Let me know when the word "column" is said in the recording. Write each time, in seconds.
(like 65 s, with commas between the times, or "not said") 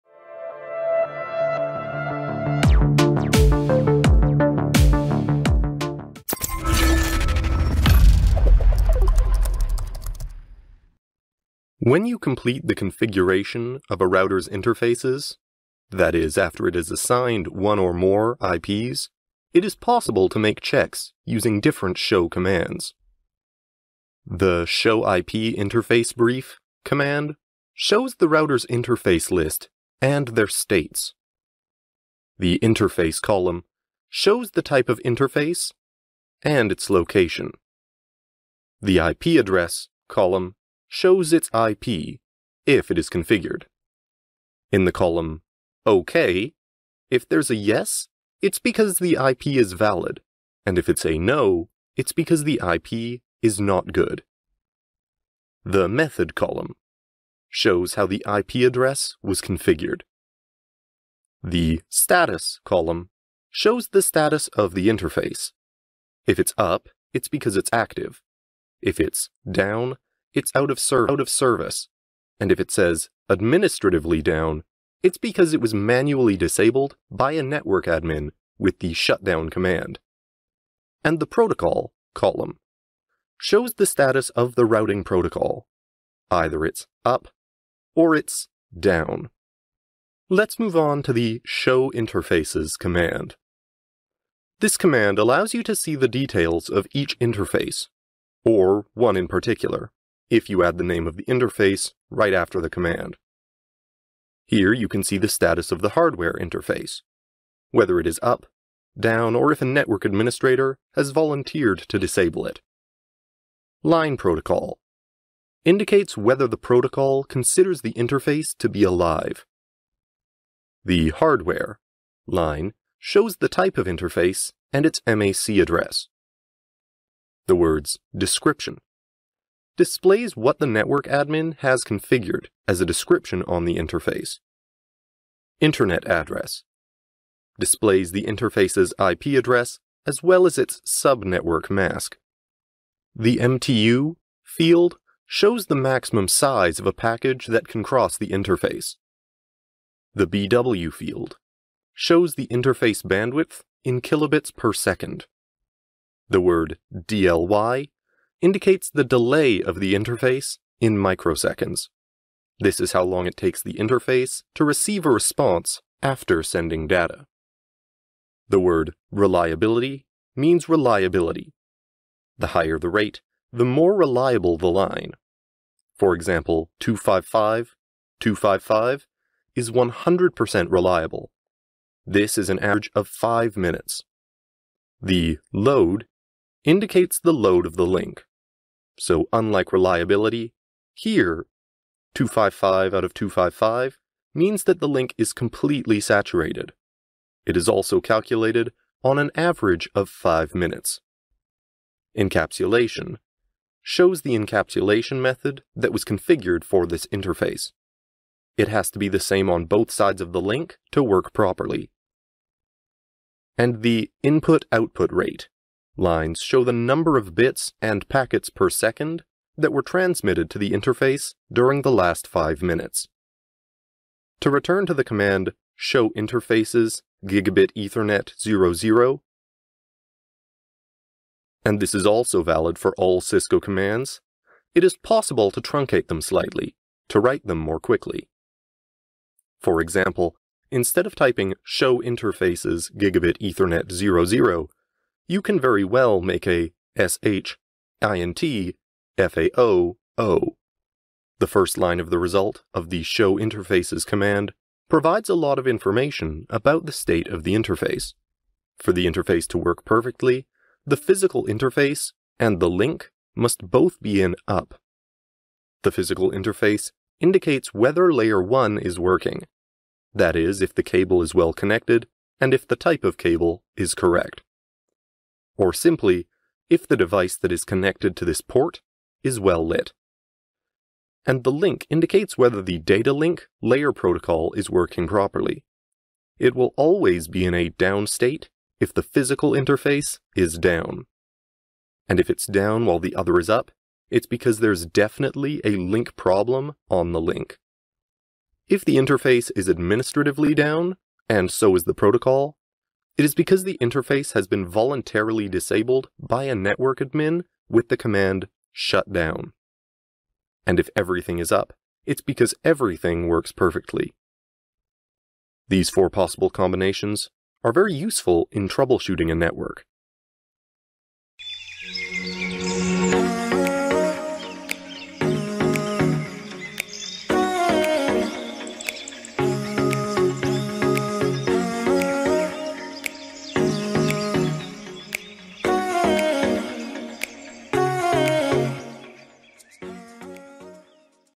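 33 s, 40 s, 44 s, 56 s, 62 s, 82 s.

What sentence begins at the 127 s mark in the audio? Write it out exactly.
The words description displays what the network admin has configured as a description on the interface.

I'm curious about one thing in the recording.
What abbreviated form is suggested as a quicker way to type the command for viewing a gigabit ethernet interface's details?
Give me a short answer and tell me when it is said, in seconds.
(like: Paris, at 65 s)
sh int fao o, at 246 s.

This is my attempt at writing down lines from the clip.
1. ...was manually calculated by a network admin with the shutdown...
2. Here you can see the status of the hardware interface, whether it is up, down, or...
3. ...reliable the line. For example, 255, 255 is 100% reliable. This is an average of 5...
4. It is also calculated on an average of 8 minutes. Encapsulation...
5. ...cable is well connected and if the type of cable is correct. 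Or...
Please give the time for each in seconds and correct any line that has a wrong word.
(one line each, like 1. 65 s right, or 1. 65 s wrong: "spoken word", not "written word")
1. 75 s wrong: "disabled", not "calculated"
2. 104 s right
3. 173 s right
4. 197 s wrong: "5", not "8"
5. 270 s right.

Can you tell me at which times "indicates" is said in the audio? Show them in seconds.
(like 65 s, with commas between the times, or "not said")
115 s, 158 s, 186 s, 267 s, 281 s.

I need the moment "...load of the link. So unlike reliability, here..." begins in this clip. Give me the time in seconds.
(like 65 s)
187 s.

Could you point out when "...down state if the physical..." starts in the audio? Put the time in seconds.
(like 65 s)
287 s.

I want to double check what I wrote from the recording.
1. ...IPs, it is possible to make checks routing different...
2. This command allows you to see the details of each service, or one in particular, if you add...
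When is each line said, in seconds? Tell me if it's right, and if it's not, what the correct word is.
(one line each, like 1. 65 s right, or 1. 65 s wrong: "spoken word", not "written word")
1. 18 s wrong: "using", not "routing"
2. 94 s wrong: "interface", not "service".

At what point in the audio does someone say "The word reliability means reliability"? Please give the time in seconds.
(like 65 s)
168 s.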